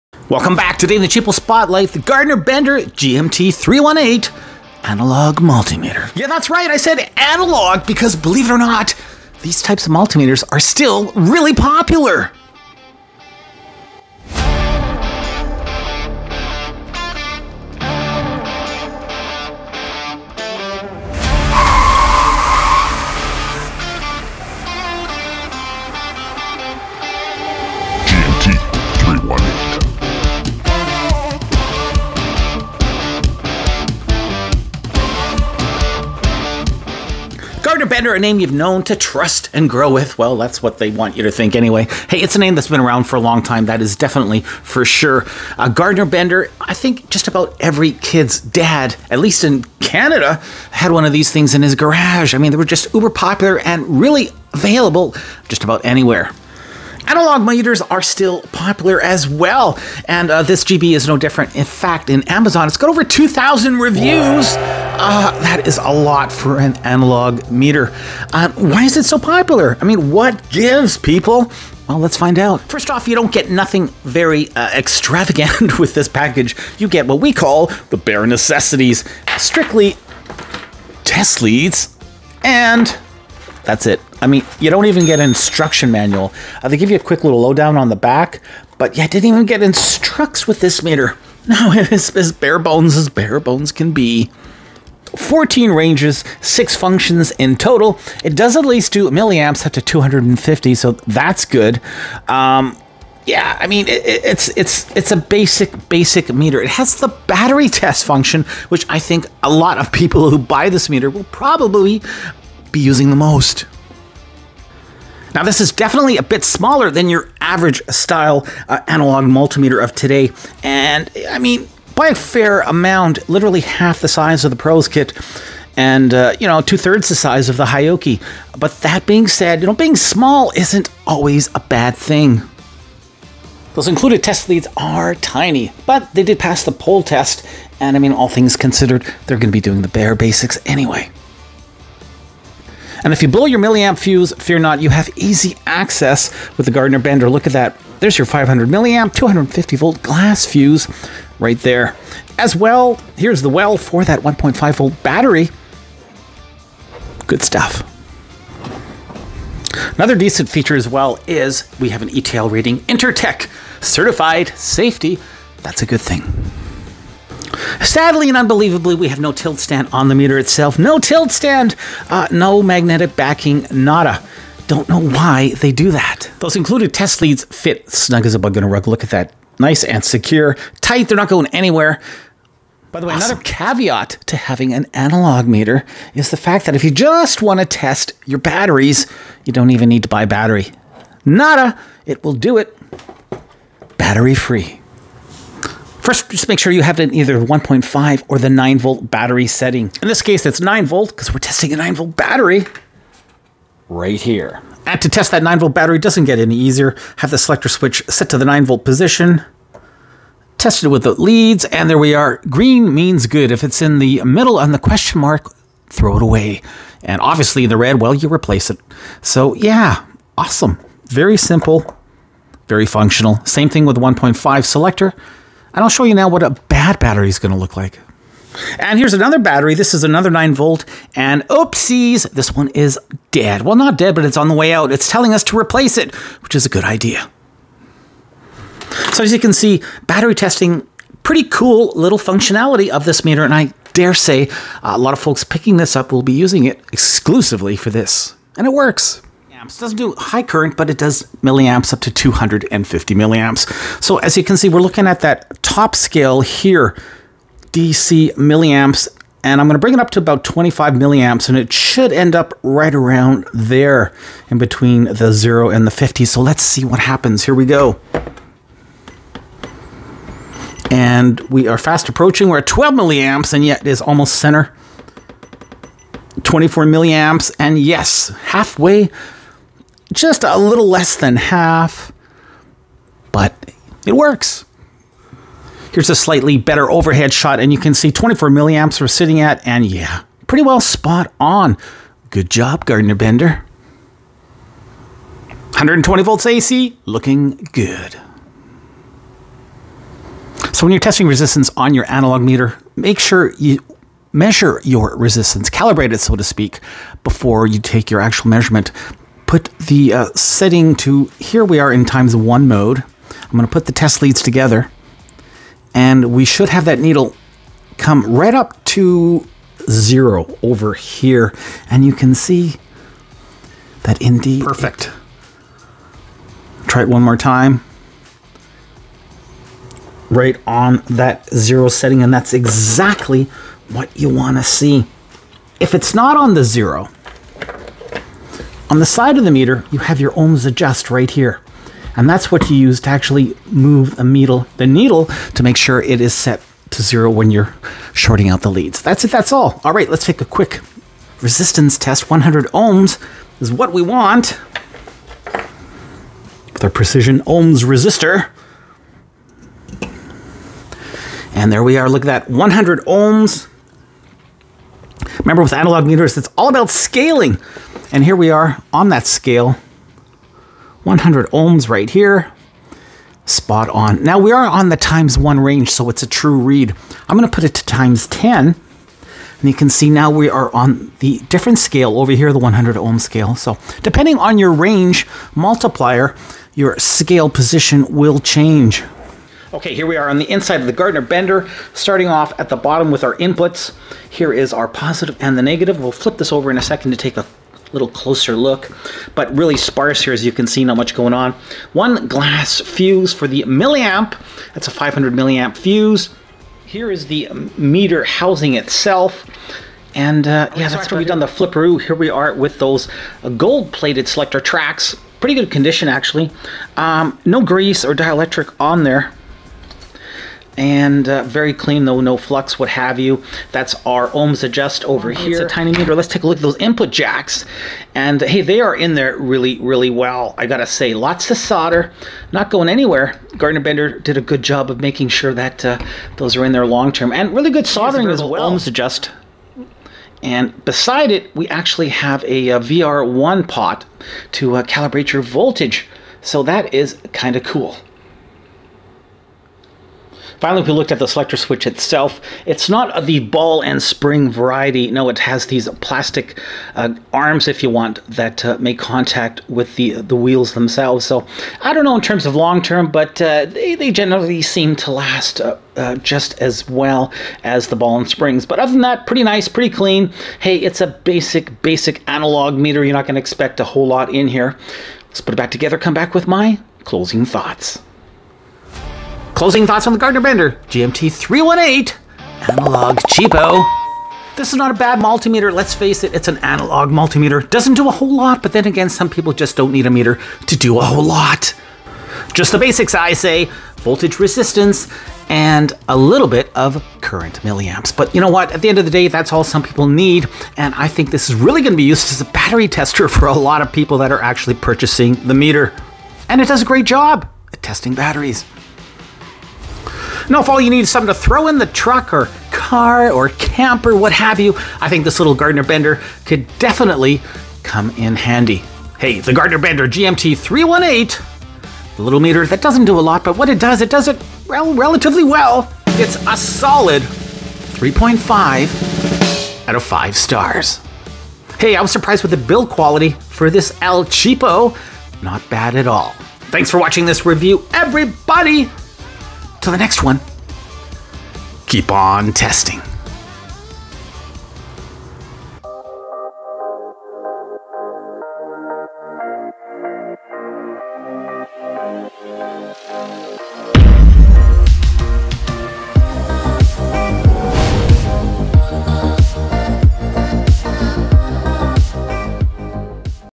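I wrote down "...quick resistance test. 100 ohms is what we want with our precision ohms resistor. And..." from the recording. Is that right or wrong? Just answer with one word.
right.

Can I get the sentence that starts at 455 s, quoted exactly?
No, it has these plastic uh, arms, if you want, that uh, make contact with the the wheels themselves.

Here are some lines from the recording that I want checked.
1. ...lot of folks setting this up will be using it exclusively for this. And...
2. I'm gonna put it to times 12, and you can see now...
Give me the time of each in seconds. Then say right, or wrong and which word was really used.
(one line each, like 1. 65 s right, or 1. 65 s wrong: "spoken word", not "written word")
1. 244 s wrong: "picking", not "setting"
2. 377 s wrong: "10", not "12".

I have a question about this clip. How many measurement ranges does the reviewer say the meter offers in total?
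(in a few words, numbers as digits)
14.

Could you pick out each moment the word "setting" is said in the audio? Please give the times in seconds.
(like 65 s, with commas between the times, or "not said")
199 s, 310 s, 331 s.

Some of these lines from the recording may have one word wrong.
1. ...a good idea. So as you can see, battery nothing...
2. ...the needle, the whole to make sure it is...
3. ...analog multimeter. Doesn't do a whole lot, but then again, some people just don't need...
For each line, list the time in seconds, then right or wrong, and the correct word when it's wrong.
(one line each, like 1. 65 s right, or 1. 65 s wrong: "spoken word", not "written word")
1. 236 s wrong: "testing", not "nothing"
2. 344 s wrong: "needle", not "whole"
3. 486 s right.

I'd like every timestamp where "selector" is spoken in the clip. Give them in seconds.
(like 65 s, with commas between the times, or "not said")
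207 s, 224 s, 414 s, 451 s.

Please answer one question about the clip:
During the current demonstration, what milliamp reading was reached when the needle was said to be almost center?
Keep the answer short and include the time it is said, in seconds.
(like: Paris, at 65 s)
12 milliamps, at 272 s.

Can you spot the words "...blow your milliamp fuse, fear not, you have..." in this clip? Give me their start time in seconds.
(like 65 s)
143 s.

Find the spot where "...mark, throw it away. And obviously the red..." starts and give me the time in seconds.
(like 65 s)
215 s.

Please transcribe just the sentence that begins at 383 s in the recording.
So depending on your range multiplier, your scale position will change.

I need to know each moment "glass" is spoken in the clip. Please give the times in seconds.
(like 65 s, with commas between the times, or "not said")
150 s, 402 s.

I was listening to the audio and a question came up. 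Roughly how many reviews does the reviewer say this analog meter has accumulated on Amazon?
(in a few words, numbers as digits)
over 2,000.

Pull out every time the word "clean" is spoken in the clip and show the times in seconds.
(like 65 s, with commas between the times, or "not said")
421 s, 469 s.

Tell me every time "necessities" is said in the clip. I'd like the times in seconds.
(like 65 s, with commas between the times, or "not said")
78 s.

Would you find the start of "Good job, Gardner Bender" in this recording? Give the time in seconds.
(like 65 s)
292 s.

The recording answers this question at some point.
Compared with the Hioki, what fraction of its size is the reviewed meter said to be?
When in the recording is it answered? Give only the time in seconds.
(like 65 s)
126 s.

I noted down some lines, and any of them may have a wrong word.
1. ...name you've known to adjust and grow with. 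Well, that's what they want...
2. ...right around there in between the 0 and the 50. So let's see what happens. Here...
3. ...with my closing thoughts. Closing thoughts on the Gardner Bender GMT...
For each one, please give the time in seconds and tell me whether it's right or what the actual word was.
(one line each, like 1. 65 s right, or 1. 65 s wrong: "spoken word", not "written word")
1. 38 s wrong: "trust", not "adjust"
2. 262 s right
3. 476 s right.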